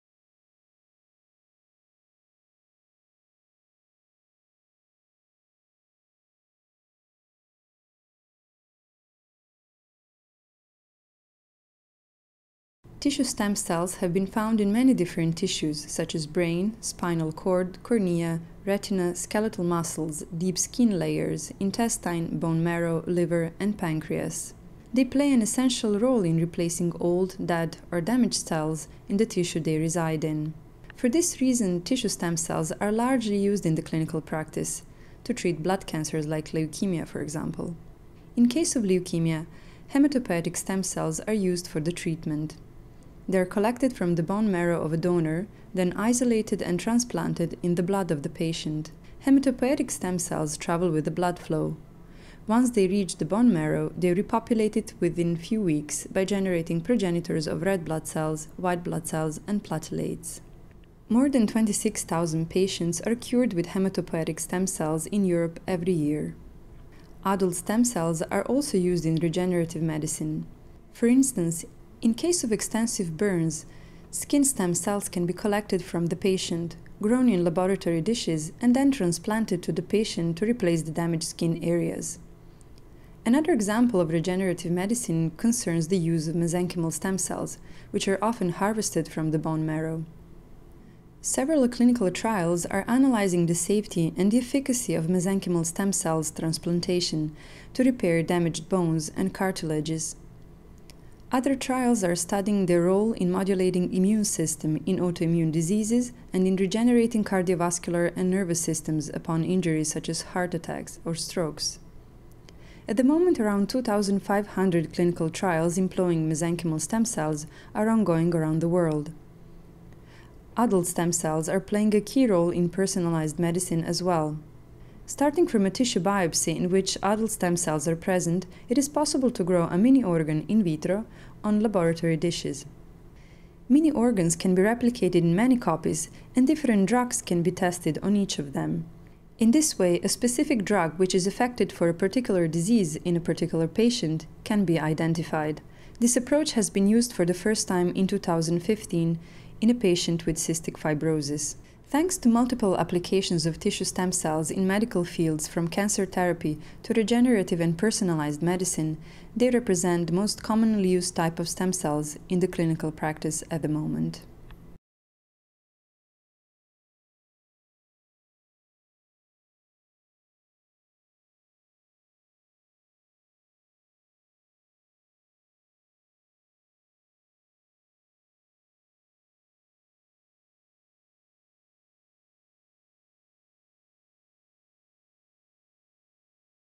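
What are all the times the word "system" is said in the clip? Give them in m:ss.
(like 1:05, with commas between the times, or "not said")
1:44, 1:48.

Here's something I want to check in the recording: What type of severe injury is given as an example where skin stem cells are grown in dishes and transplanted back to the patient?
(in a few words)
Extensive burns.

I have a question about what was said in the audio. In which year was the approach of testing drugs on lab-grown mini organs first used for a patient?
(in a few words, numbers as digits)
2015.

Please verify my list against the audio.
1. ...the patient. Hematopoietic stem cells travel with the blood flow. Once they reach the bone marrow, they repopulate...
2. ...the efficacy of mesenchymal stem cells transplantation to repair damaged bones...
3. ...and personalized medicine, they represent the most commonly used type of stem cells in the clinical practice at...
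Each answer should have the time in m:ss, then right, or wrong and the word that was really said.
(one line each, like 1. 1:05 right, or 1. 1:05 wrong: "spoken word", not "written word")
1. 0:48 right
2. 1:34 right
3. 2:37 right.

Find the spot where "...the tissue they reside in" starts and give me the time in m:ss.
0:29.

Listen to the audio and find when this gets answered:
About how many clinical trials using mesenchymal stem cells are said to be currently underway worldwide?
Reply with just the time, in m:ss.
1:53.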